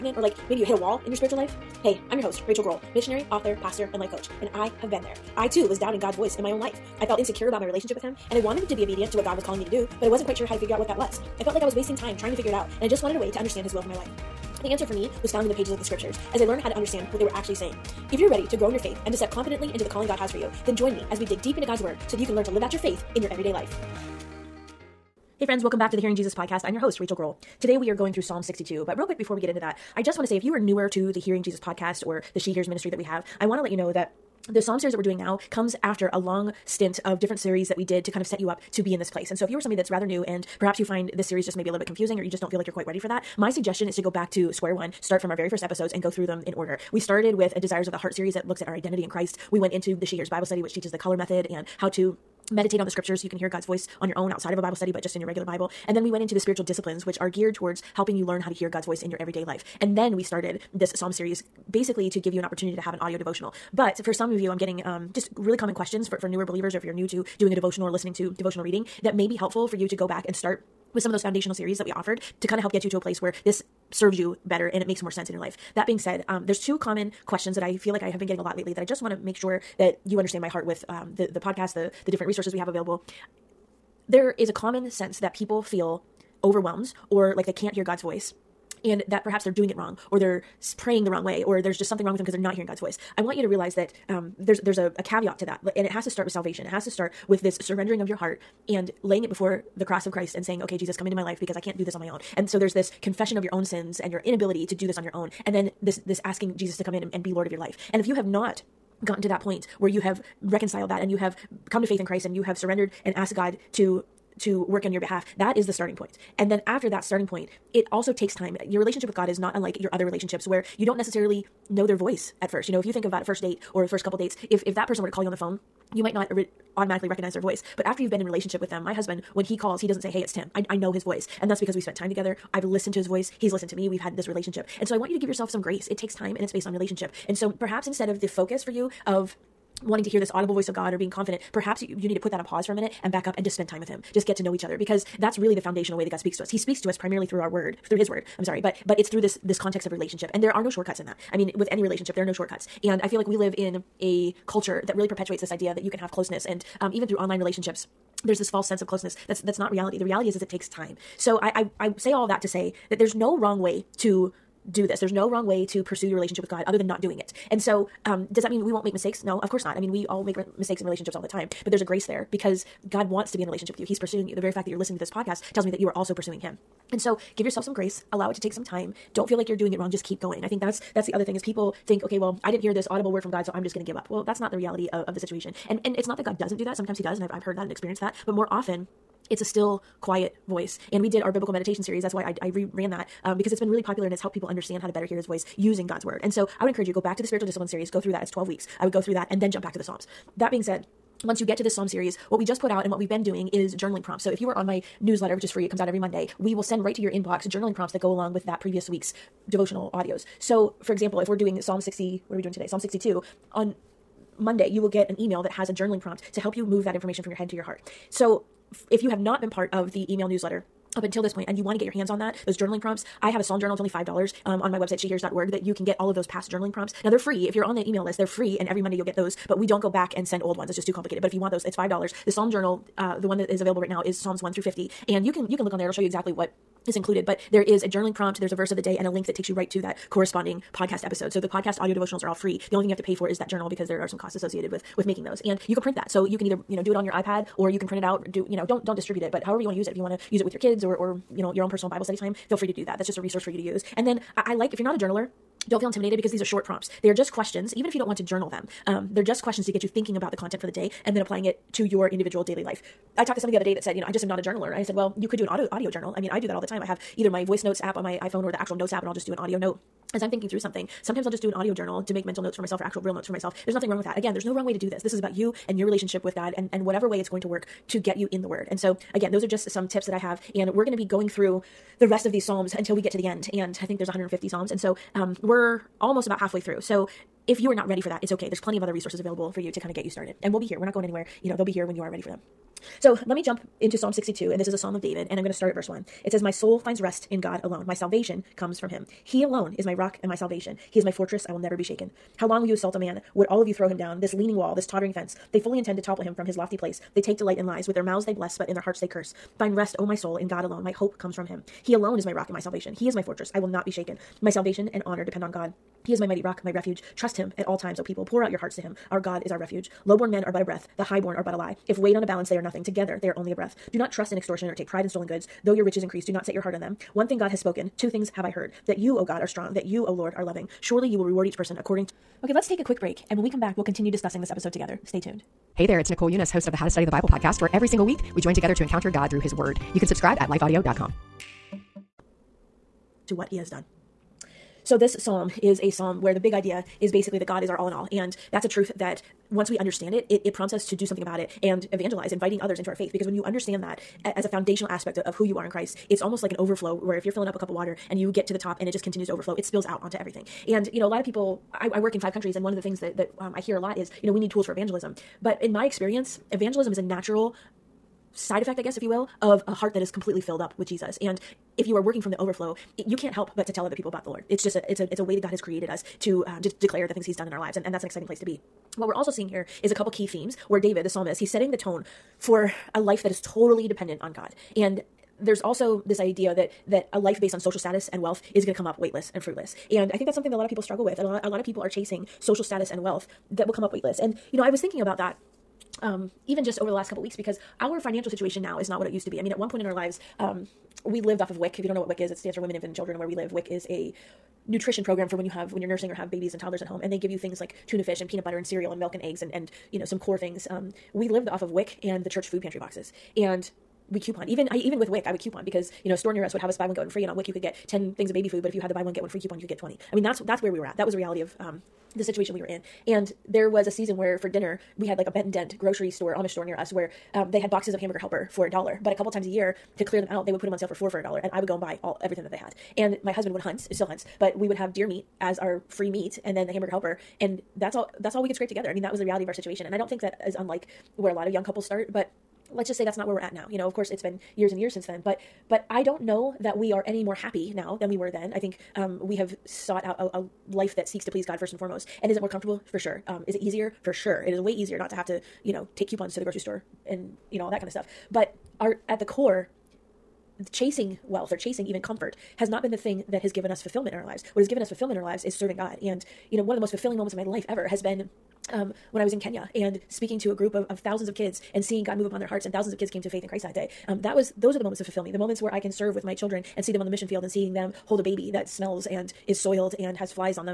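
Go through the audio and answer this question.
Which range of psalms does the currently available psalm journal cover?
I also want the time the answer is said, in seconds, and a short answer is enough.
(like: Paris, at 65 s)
Psalms 1 through 50, at 234 s.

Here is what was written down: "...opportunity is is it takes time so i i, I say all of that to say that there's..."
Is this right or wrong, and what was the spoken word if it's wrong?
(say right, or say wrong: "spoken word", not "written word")
wrong: "reality", not "opportunity".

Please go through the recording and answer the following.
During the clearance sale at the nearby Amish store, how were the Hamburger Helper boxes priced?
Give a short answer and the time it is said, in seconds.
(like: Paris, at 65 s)
4 for a dollar, at 430 s.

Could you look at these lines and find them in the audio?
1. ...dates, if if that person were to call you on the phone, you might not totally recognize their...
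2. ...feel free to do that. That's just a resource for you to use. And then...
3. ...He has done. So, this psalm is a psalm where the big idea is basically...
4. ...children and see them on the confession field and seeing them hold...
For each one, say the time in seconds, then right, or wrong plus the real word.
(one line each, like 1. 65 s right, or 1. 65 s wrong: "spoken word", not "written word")
1. 124 s wrong: "automatically", not "totally"
2. 252 s right
3. 343 s right
4. 476 s wrong: "mission", not "confession".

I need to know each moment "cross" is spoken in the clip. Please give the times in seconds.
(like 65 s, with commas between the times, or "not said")
99 s.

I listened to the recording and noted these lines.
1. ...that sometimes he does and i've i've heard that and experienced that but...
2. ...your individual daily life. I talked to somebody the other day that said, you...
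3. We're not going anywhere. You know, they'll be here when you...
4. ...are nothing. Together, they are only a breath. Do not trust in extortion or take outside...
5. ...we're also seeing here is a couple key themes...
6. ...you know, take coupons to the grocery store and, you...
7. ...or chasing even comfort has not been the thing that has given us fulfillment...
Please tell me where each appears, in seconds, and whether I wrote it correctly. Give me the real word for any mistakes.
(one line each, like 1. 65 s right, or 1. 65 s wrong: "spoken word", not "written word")
1. 186 s right
2. 261 s right
3. 290 s right
4. 322 s wrong: "pride", not "outside"
5. 379 s right
6. 455 s right
7. 461 s right.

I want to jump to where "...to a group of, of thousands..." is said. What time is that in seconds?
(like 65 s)
470 s.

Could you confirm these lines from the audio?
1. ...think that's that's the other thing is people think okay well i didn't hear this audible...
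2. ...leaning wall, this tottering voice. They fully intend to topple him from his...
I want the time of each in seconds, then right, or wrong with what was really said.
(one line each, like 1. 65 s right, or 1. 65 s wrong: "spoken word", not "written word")
1. 180 s right
2. 304 s wrong: "fence", not "voice".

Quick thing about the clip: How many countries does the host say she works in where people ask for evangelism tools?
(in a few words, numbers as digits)
5.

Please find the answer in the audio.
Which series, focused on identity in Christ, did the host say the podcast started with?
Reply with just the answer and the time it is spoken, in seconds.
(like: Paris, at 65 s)
Desires of the Heart, at 47 s.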